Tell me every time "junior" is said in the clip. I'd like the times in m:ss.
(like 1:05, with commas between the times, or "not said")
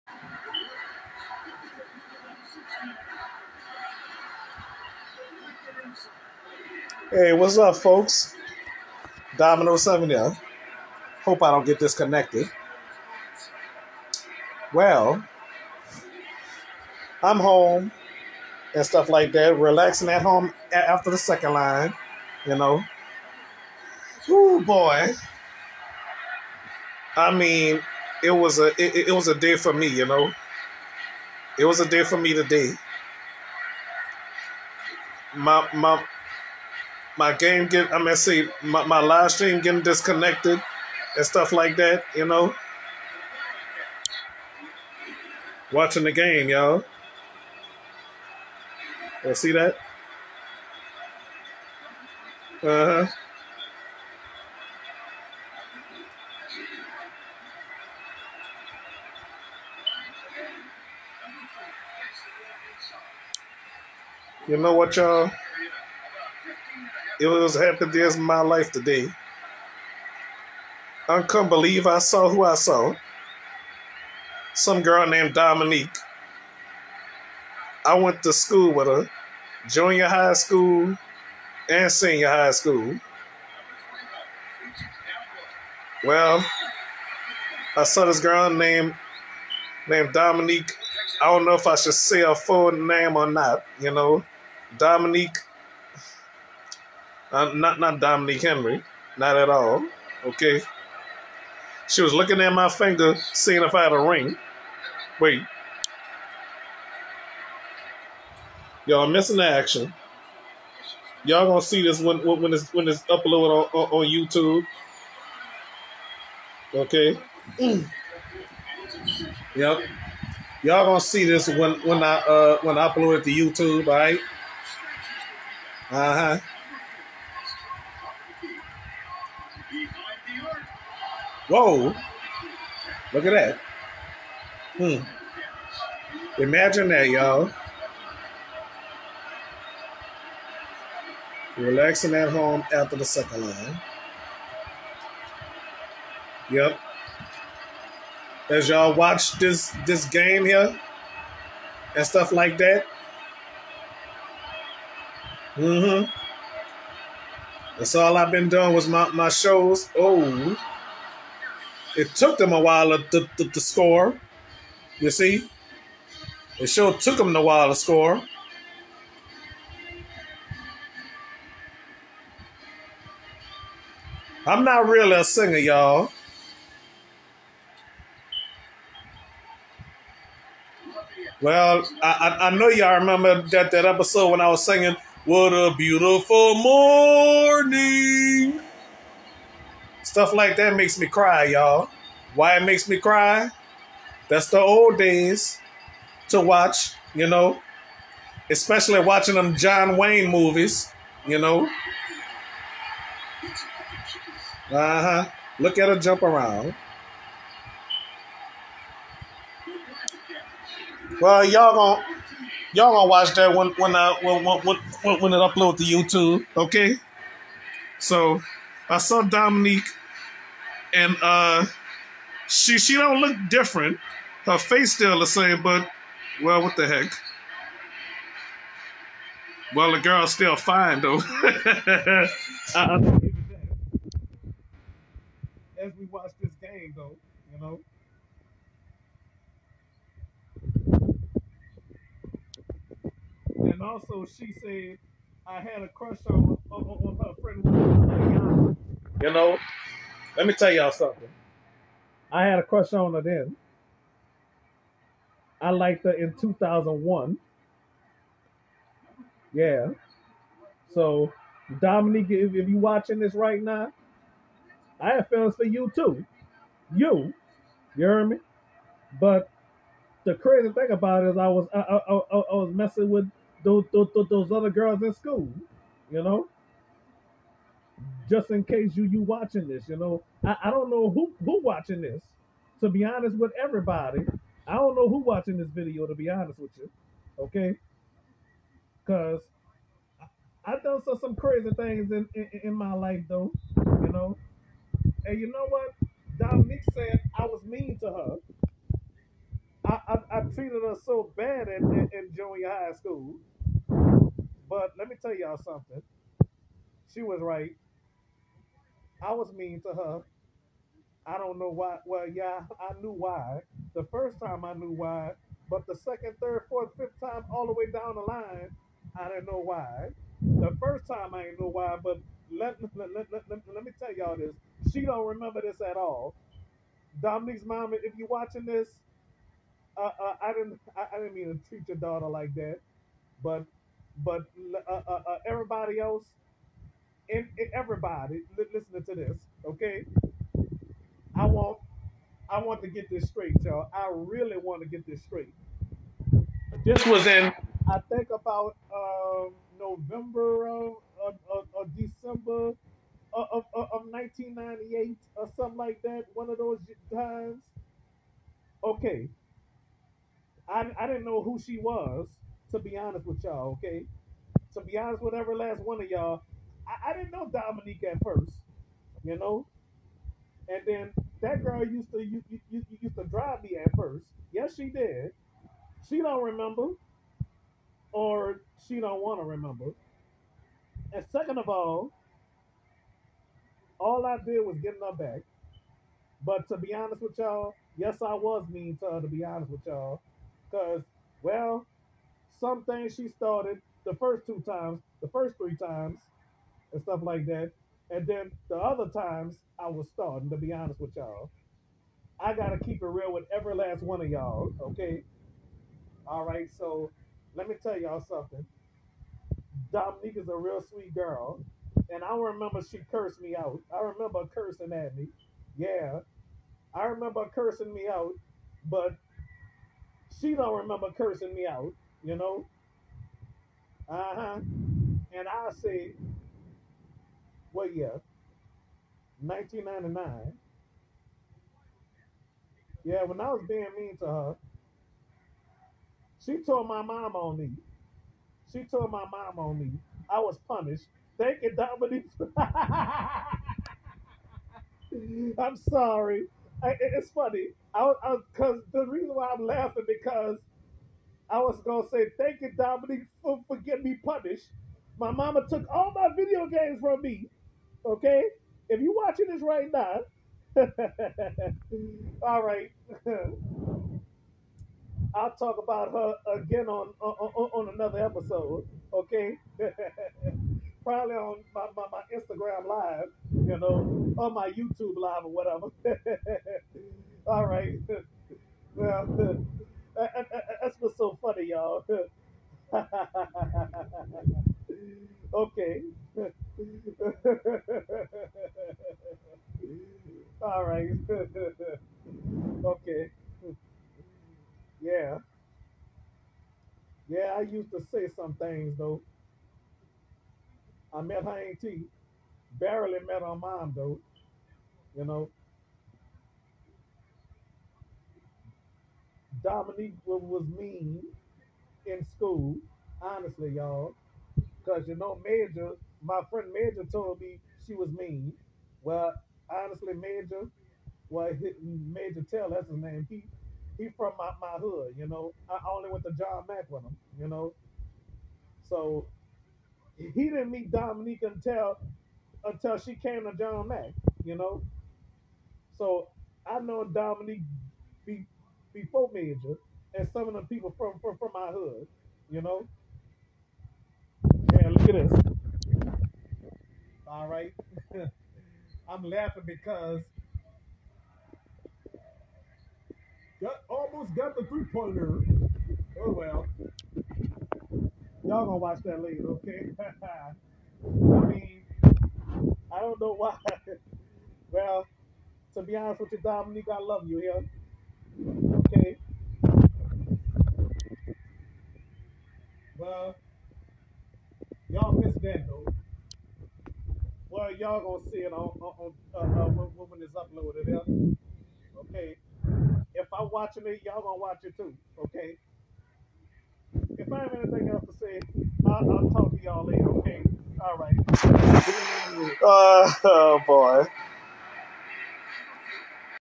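1:19, 5:02.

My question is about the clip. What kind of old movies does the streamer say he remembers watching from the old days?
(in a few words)
John Wayne movies.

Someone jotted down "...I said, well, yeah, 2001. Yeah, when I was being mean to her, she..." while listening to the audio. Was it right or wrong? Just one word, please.
wrong.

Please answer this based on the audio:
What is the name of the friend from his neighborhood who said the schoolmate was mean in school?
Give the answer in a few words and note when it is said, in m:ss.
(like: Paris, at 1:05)
Major Tell, at 8:42.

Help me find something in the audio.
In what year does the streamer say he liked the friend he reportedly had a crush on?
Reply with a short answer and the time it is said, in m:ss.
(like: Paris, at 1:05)
2001, at 4:16.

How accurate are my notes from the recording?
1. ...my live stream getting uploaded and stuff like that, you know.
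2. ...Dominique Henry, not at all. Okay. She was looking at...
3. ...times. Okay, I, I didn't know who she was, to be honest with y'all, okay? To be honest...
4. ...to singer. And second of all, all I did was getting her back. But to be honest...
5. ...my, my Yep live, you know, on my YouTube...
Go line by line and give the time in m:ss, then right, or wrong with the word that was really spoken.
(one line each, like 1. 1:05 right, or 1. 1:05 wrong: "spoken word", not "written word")
1. 0:38 wrong: "disconnected", not "uploaded"
2. 1:37 right
3. 5:57 right
4. 6:19 wrong: "remember", not "singer"
5. 7:51 wrong: "Instagram", not "Yep".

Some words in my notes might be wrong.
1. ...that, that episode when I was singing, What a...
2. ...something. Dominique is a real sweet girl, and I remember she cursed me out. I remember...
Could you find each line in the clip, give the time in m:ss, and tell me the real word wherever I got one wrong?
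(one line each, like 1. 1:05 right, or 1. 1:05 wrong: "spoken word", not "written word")
1. 3:03 right
2. 6:48 right.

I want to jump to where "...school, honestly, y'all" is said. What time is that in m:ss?
8:32.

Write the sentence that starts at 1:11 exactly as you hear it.
I couldn't believe I saw who I saw.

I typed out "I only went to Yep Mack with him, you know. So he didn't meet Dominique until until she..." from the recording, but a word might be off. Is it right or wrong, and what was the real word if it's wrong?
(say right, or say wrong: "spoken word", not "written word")
wrong: "John", not "Yep".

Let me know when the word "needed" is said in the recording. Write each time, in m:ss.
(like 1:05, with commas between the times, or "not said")
not said.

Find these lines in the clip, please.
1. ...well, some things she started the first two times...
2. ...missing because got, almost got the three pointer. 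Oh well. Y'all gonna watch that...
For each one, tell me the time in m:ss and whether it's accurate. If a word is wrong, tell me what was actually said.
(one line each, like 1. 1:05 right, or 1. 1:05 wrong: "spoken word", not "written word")
1. 6:31 right
2. 9:09 wrong: "laughing", not "missing".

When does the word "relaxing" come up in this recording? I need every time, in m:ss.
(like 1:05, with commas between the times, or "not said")
0:19, 2:21.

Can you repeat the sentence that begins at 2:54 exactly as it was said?
I'm not really a singer, y'all.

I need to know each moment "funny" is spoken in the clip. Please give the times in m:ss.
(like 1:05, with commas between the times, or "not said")
7:27, 8:01.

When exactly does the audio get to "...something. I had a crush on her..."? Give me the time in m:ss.
4:10.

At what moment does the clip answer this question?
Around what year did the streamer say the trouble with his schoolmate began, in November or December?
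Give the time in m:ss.
5:54.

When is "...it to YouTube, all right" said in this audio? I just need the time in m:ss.
2:03.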